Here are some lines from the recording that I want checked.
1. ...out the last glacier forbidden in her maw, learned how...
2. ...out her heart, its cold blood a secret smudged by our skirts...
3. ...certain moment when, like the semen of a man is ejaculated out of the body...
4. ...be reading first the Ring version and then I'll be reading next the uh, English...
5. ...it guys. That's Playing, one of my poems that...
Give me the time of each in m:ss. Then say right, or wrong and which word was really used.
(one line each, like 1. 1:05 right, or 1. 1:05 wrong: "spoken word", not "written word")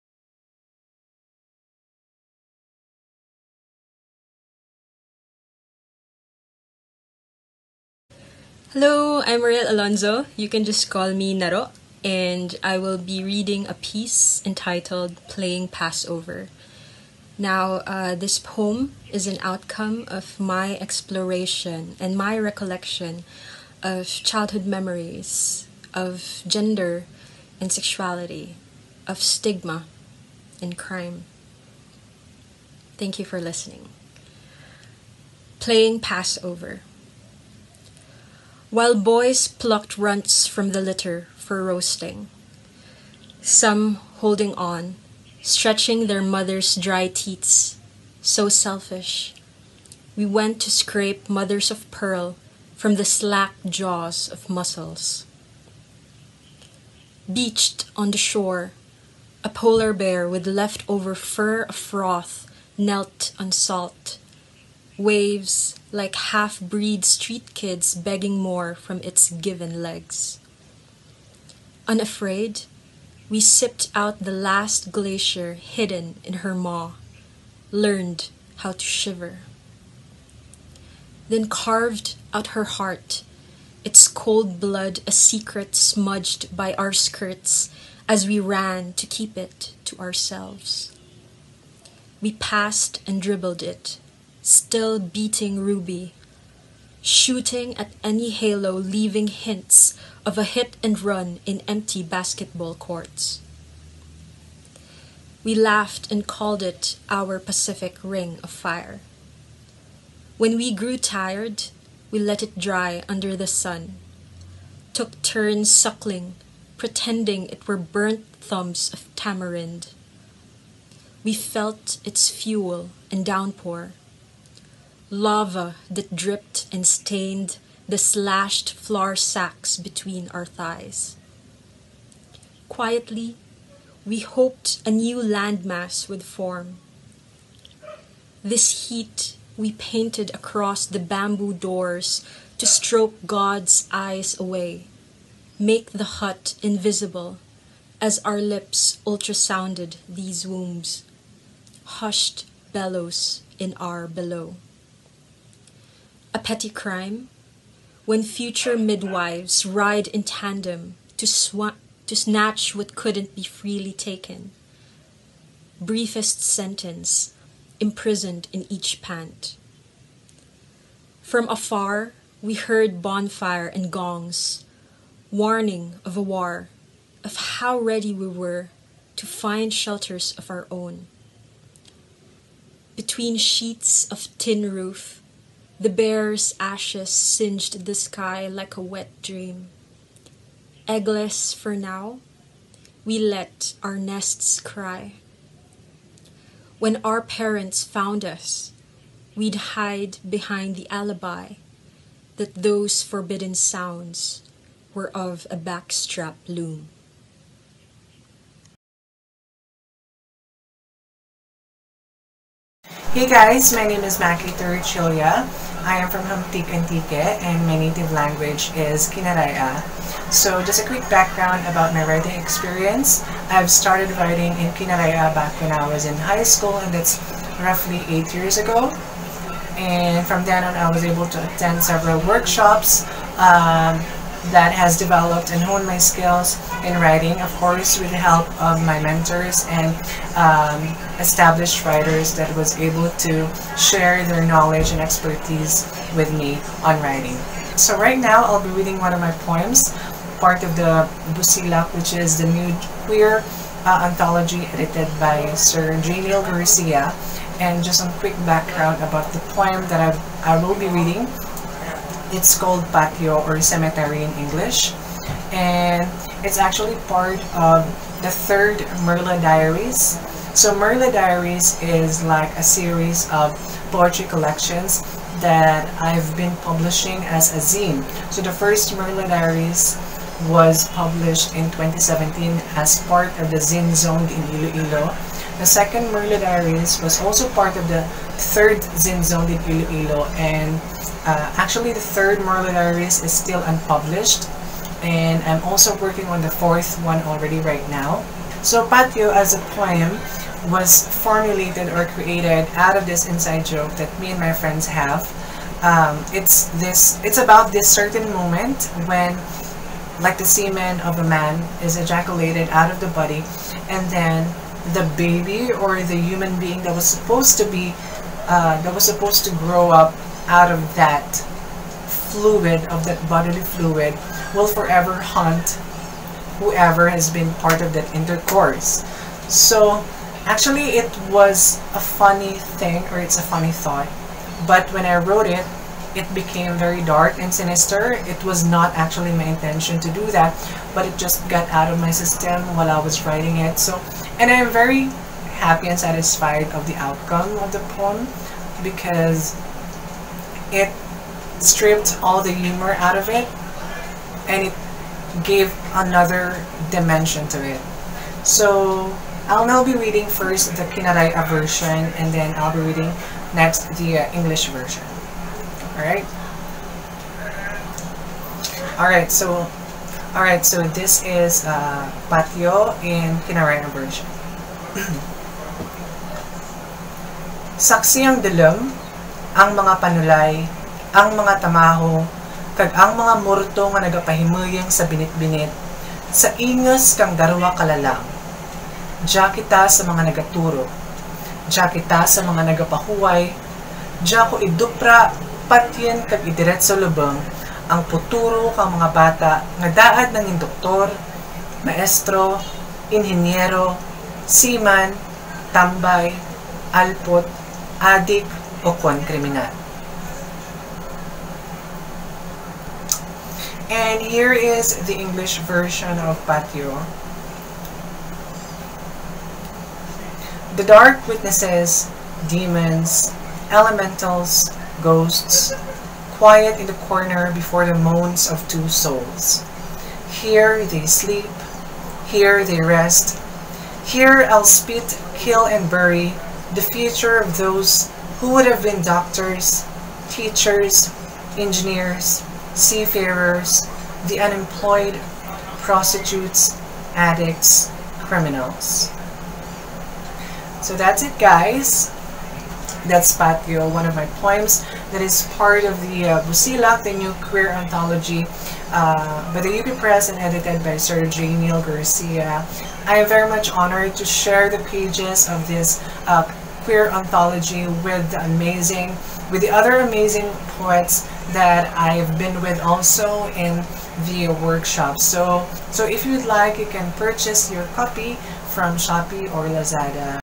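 1. 1:13 wrong: "hidden", not "forbidden"
2. 1:22 right
3. 5:07 right
4. 5:59 wrong: "Kinaraya", not "Ring"
5. 7:31 wrong: "Patio", not "Playing".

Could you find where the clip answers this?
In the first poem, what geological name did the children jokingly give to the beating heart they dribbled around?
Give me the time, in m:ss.
1:47.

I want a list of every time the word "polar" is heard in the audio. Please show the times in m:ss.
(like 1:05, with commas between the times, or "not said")
0:59.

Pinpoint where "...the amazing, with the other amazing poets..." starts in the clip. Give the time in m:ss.
7:48.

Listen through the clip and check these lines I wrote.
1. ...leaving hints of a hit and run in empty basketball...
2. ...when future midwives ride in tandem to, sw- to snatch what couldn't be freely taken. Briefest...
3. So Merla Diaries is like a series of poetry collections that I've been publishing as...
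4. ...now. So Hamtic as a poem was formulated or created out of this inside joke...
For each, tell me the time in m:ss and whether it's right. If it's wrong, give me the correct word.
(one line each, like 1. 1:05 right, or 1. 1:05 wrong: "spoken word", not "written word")
1. 1:38 right
2. 2:38 right
3. 4:30 right
4. 4:57 wrong: "Patio", not "Hamtic".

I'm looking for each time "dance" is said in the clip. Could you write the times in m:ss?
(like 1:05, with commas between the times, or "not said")
not said.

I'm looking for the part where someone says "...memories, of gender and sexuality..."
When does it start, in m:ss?
0:24.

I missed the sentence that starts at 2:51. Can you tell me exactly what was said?
From afar, we heard bonfire and gongs, warning of a war, of how ready we were to find shelters of our own.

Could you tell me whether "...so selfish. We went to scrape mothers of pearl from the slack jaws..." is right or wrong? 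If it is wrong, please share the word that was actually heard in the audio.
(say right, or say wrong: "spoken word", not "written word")
right.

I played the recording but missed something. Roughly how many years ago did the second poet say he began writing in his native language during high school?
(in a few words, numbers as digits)
eight years.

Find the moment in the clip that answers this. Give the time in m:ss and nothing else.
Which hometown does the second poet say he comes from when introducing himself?
3:36.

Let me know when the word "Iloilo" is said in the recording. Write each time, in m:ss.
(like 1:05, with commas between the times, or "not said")
4:44, 4:49.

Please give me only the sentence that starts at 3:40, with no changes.
So just a quick background about my writing experience.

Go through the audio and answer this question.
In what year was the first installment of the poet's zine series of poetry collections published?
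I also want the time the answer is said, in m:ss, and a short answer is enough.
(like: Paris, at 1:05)
2017, at 4:41.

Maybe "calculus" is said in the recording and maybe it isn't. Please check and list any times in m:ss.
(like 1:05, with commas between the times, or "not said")
not said.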